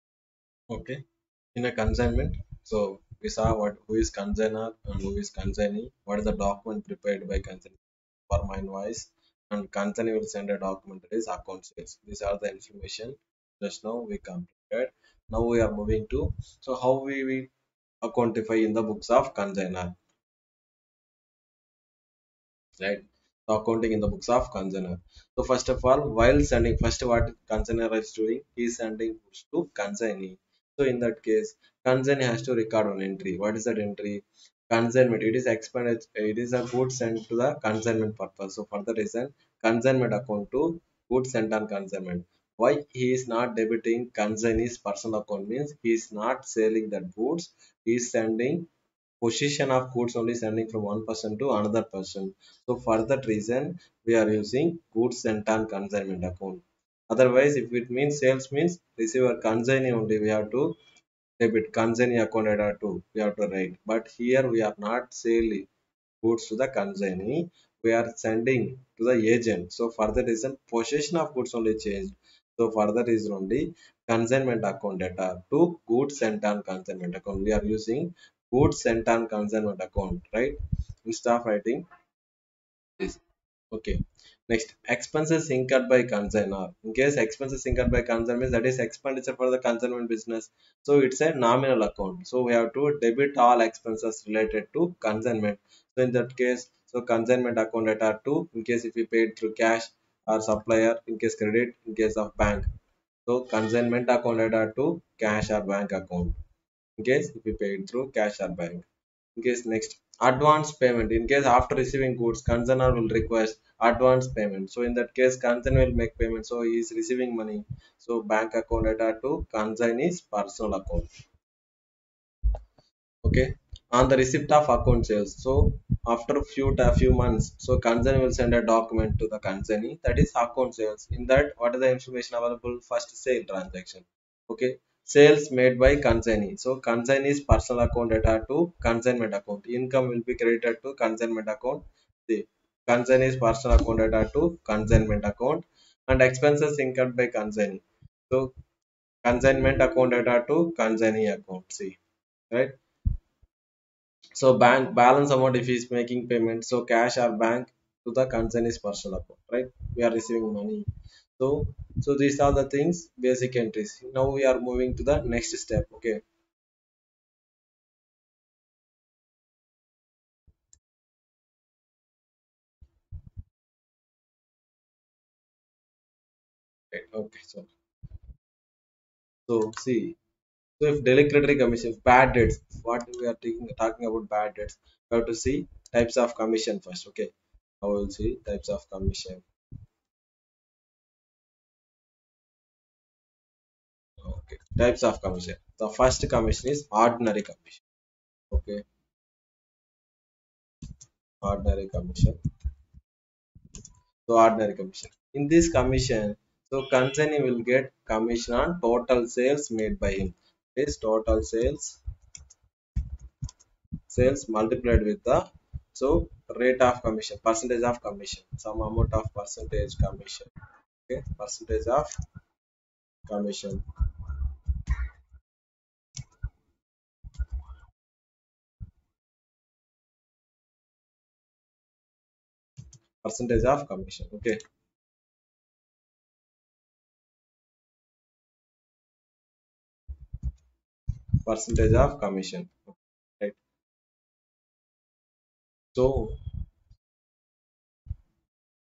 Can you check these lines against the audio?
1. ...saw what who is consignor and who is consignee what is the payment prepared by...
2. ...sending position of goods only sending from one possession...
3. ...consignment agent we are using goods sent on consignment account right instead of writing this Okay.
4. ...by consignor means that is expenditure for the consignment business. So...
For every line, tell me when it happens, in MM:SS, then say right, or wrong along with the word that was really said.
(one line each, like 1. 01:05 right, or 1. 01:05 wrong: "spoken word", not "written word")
1. 00:03 wrong: "document", not "payment"
2. 00:48 wrong: "person", not "possession"
3. 01:16 wrong: "account", not "agent"
4. 01:27 right.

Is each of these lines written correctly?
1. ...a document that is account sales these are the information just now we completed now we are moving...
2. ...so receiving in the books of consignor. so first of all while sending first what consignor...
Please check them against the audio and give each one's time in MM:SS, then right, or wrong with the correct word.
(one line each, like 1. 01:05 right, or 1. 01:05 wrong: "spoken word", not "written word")
1. 00:10 right
2. 00:23 wrong: "accounting", not "receiving".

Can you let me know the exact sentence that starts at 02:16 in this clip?
So consignee's personal account data to consignment account.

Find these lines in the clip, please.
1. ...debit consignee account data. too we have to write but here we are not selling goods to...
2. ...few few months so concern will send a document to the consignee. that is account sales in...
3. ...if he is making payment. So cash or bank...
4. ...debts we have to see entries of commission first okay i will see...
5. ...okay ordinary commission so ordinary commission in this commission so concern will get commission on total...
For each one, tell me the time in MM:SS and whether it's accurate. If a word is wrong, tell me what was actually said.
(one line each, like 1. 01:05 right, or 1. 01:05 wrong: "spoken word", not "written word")
1. 01:01 right
2. 02:06 right
3. 02:35 right
4. 03:04 wrong: "types", not "entries"
5. 03:18 right.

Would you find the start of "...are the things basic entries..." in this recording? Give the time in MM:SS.
02:42.